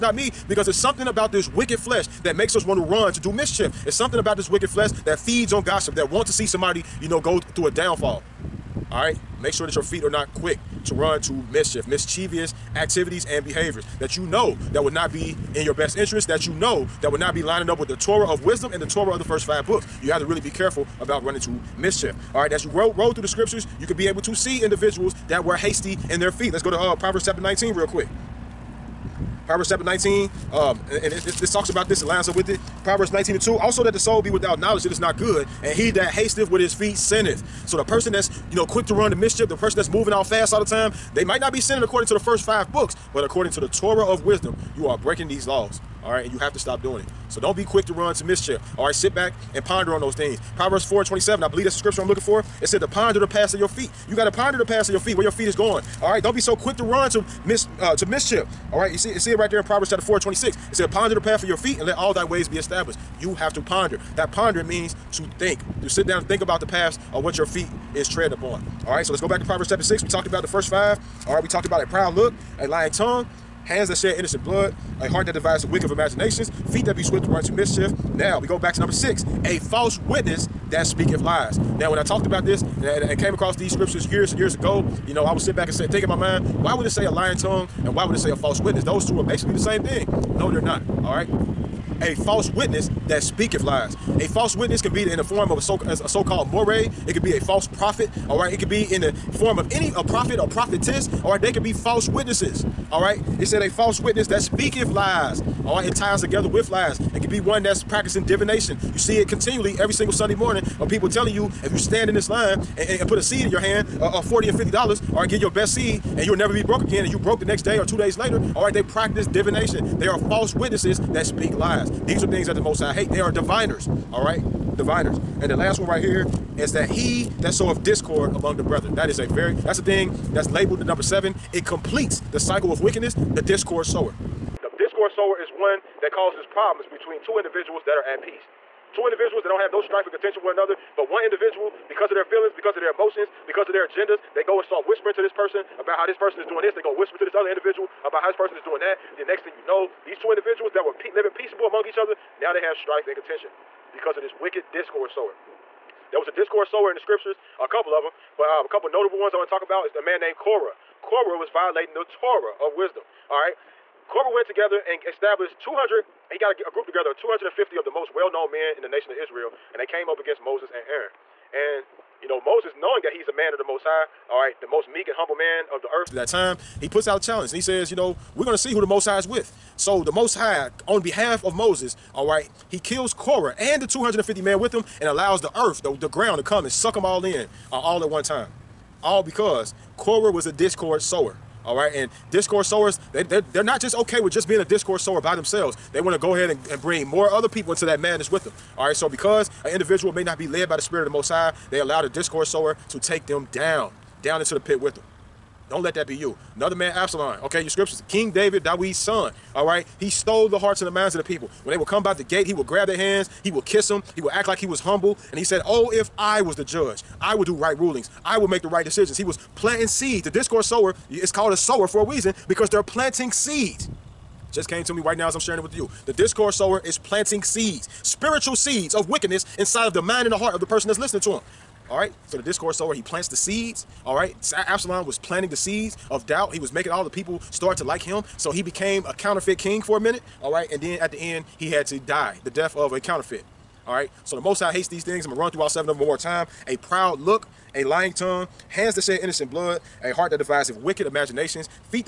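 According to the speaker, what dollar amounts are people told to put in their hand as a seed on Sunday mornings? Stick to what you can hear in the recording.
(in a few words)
40 and 50 dollars.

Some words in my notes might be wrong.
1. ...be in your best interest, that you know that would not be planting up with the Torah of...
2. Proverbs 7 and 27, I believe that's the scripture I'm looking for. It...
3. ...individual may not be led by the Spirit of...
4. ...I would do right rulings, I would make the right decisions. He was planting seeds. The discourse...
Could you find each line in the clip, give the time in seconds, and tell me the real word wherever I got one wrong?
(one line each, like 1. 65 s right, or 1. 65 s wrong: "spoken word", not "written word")
1. 15 s wrong: "lining", not "planting"
2. 50 s wrong: "4", not "7"
3. 199 s right
4. 217 s right.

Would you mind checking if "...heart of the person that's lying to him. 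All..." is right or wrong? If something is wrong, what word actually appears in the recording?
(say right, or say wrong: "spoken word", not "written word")
wrong: "listening", not "lying".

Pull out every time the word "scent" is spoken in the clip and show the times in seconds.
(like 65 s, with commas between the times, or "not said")
not said.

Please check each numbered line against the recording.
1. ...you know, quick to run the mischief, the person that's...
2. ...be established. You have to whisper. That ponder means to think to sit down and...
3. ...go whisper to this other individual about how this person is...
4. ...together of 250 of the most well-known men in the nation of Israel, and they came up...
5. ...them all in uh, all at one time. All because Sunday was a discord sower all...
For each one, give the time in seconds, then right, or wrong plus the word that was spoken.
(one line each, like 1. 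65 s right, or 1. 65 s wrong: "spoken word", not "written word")
1. 38 s right
2. 62 s wrong: "ponder", not "whisper"
3. 146 s right
4. 166 s right
5. 186 s wrong: "Korah", not "Sunday".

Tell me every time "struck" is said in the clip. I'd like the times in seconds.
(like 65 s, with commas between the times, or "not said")
not said.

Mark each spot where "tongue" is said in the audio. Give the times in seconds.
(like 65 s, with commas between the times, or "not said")
72 s, 87 s, 248 s.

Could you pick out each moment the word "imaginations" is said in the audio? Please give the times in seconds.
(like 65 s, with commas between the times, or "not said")
75 s, 251 s.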